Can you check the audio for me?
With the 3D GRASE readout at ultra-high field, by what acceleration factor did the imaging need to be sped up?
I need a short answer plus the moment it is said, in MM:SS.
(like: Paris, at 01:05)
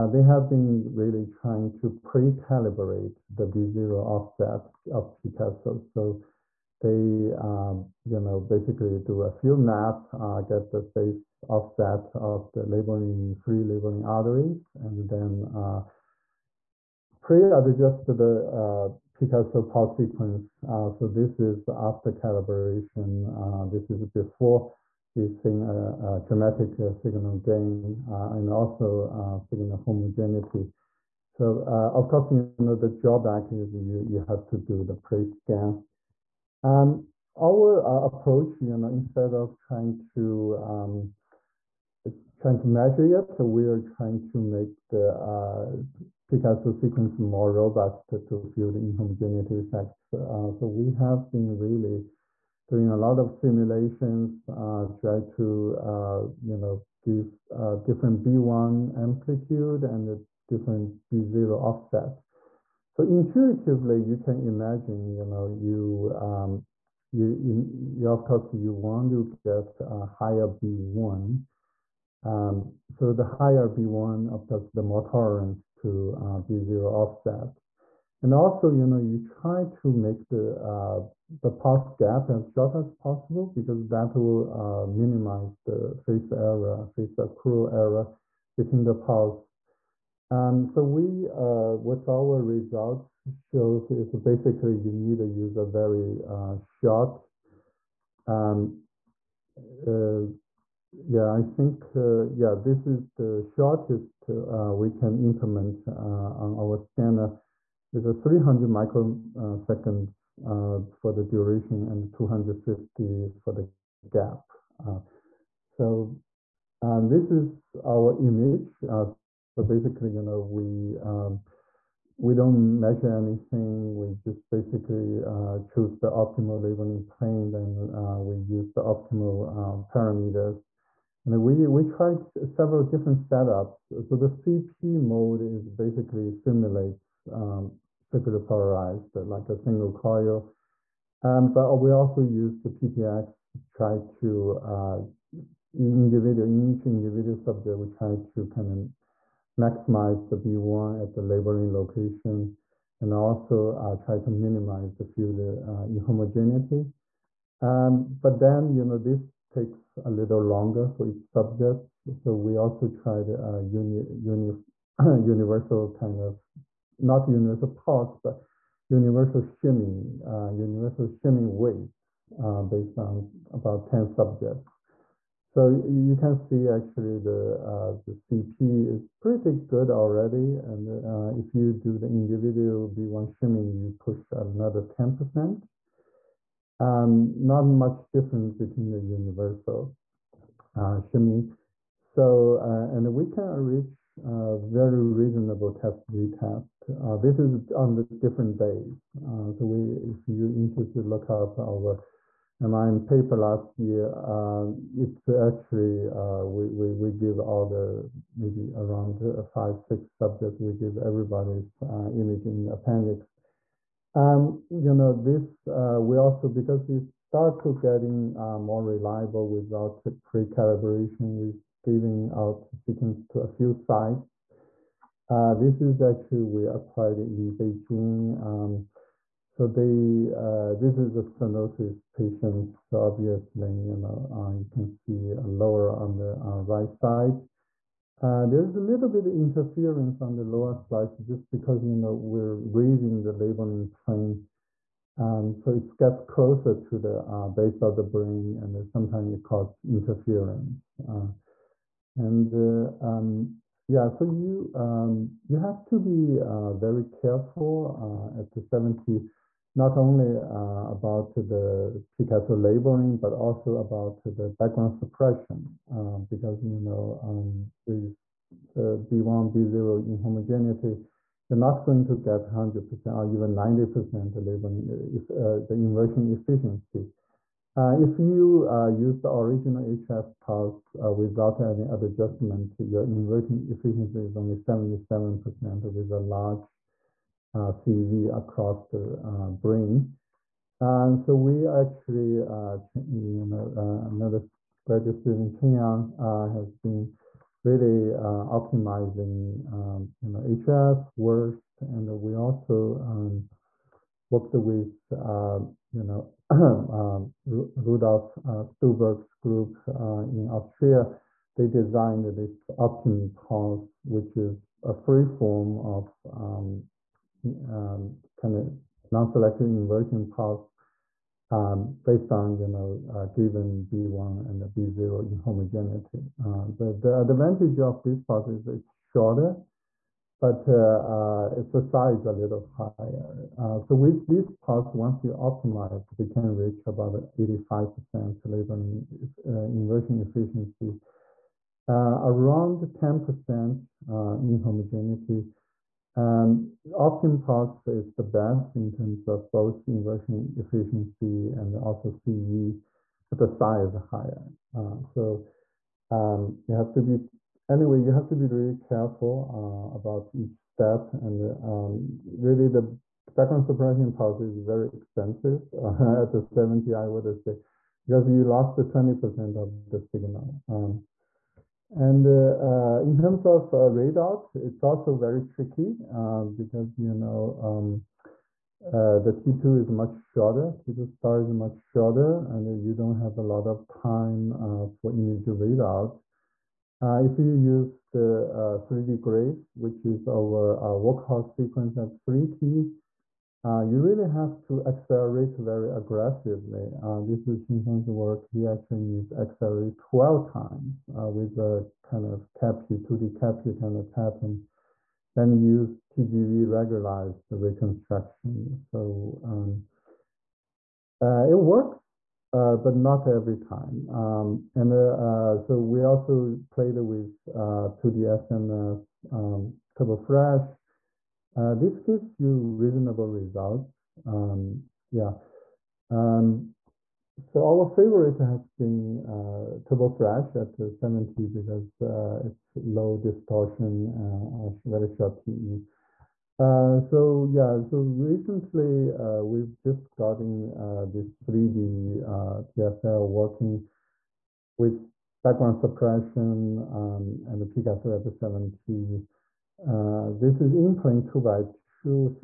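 12, at 06:39.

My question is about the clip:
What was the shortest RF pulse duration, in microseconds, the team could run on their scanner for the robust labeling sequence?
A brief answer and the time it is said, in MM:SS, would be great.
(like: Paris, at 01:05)
300, at 01:48.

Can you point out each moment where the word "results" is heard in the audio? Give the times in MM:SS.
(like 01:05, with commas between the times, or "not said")
01:32, 07:03.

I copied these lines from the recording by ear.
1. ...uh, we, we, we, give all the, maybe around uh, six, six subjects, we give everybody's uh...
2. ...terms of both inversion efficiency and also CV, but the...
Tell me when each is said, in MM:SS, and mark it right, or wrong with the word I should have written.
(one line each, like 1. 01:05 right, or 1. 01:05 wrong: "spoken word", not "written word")
1. 03:26 wrong: "five", not "six"
2. 05:48 right.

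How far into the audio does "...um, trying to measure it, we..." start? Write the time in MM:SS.
00:40.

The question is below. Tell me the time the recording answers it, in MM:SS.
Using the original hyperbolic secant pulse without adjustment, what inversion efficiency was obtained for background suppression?
04:44.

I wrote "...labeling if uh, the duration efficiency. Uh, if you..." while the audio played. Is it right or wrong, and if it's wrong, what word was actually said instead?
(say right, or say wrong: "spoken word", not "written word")
wrong: "inversion", not "duration".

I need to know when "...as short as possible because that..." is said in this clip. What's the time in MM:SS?
01:22.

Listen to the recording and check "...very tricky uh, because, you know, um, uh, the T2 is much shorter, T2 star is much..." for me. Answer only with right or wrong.
right.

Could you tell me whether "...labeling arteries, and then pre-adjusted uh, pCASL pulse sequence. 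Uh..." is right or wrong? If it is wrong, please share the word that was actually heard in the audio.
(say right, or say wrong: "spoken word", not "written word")
right.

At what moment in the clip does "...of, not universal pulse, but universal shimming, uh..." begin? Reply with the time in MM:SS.
02:46.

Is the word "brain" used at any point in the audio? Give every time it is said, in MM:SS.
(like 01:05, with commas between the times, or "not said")
04:08, 04:49.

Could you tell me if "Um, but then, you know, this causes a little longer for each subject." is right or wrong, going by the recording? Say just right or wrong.
wrong.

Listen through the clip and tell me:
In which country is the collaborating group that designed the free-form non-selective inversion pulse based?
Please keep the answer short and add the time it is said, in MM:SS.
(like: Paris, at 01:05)
Austria, at 05:10.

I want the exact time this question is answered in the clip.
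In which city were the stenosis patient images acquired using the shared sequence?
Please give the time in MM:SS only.
03:47.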